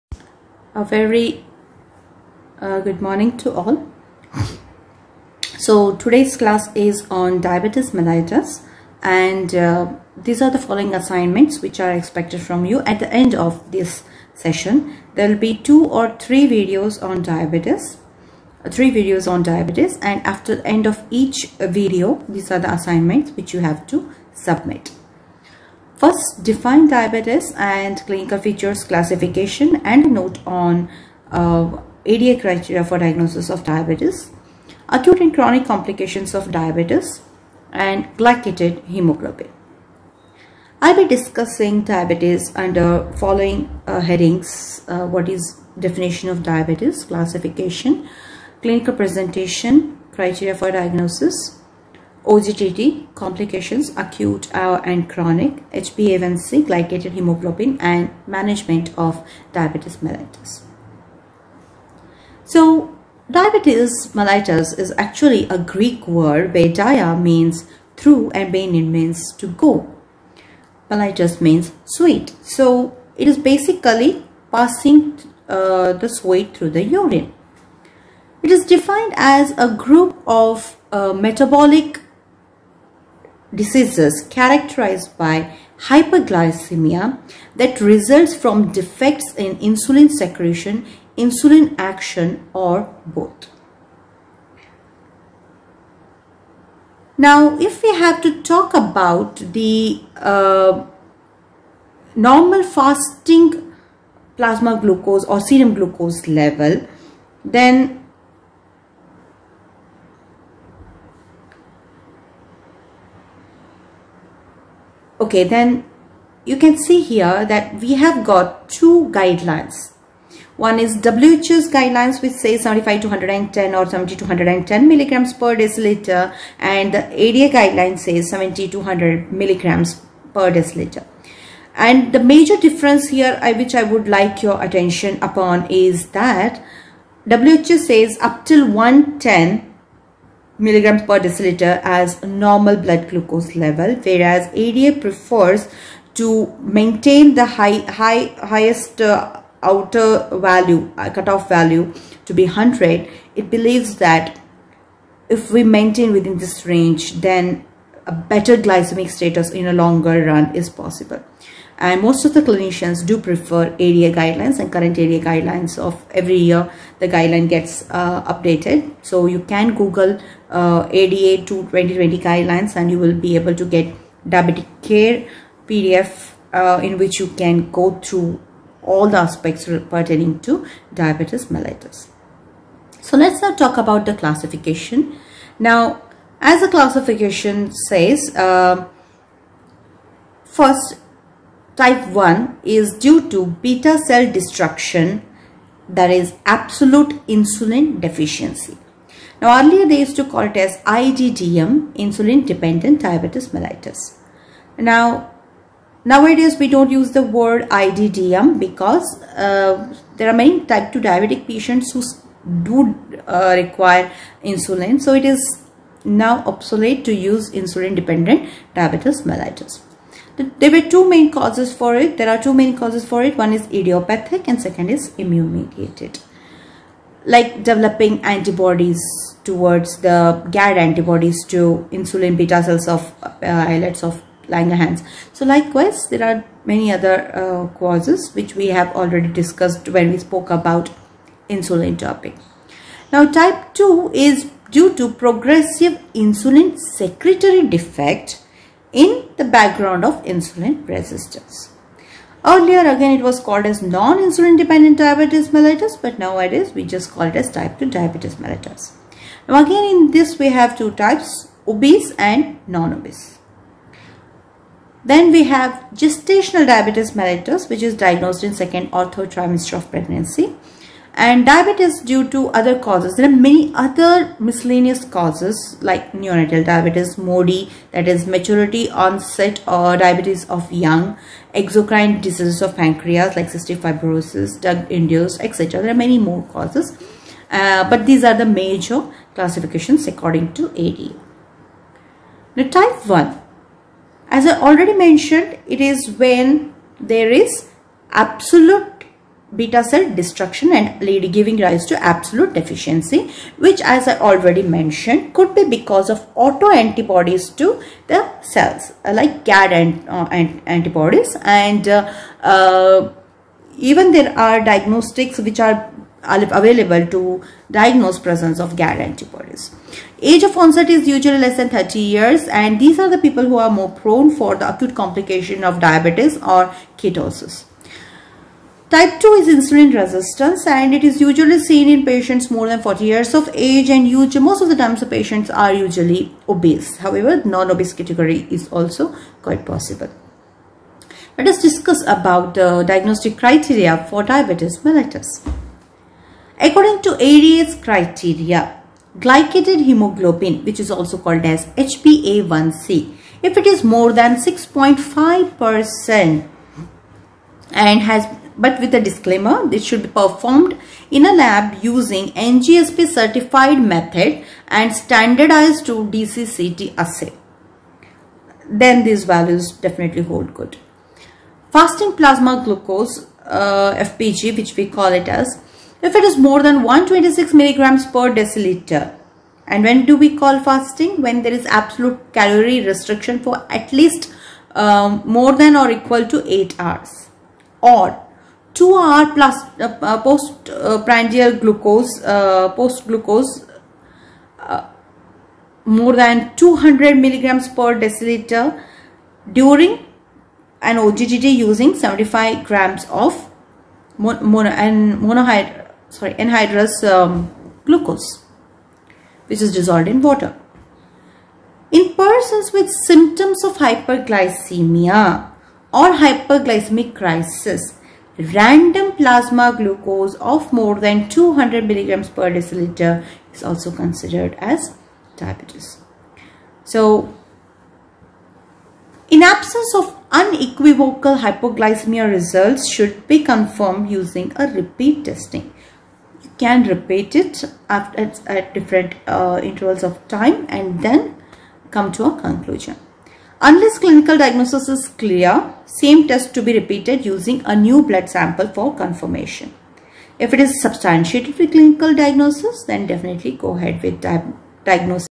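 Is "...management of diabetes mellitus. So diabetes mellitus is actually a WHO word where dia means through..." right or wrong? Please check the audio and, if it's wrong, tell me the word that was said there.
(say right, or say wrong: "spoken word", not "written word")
wrong: "Greek", not "WHO".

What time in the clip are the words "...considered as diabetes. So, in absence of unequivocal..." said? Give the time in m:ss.
7:03.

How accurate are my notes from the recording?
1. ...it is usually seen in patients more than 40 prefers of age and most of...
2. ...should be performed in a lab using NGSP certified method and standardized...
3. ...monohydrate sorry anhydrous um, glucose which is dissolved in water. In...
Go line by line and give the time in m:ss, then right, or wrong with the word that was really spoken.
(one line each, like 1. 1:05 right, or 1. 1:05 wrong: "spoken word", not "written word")
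1. 5:30 wrong: "years", not "prefers"
2. 5:59 right
3. 6:45 right.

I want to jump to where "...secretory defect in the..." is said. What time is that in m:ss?
4:06.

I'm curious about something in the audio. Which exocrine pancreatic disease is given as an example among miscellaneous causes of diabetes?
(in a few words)
cystic fibrosis.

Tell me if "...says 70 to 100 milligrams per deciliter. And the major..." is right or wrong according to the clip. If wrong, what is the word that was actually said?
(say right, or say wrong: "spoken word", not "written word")
right.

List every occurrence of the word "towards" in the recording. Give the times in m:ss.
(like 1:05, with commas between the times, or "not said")
3:49.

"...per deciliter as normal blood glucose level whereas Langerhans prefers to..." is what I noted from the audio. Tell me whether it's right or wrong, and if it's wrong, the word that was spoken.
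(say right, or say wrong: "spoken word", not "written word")
wrong: "ADA", not "Langerhans".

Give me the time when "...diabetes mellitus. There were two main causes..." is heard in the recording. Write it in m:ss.
3:38.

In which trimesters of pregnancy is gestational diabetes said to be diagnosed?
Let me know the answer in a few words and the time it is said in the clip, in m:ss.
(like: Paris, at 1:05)
second or third, at 4:28.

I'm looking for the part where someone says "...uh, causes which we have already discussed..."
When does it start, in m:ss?
3:57.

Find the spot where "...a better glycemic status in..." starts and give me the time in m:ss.
2:38.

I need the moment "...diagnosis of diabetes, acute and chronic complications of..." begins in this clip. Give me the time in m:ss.
0:32.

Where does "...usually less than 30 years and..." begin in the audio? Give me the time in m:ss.
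5:21.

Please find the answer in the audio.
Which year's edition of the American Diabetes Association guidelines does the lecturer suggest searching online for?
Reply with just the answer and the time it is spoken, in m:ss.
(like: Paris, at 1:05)
2020, at 2:50.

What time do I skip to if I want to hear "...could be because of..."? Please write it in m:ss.
5:05.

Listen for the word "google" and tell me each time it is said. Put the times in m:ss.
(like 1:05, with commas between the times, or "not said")
2:49.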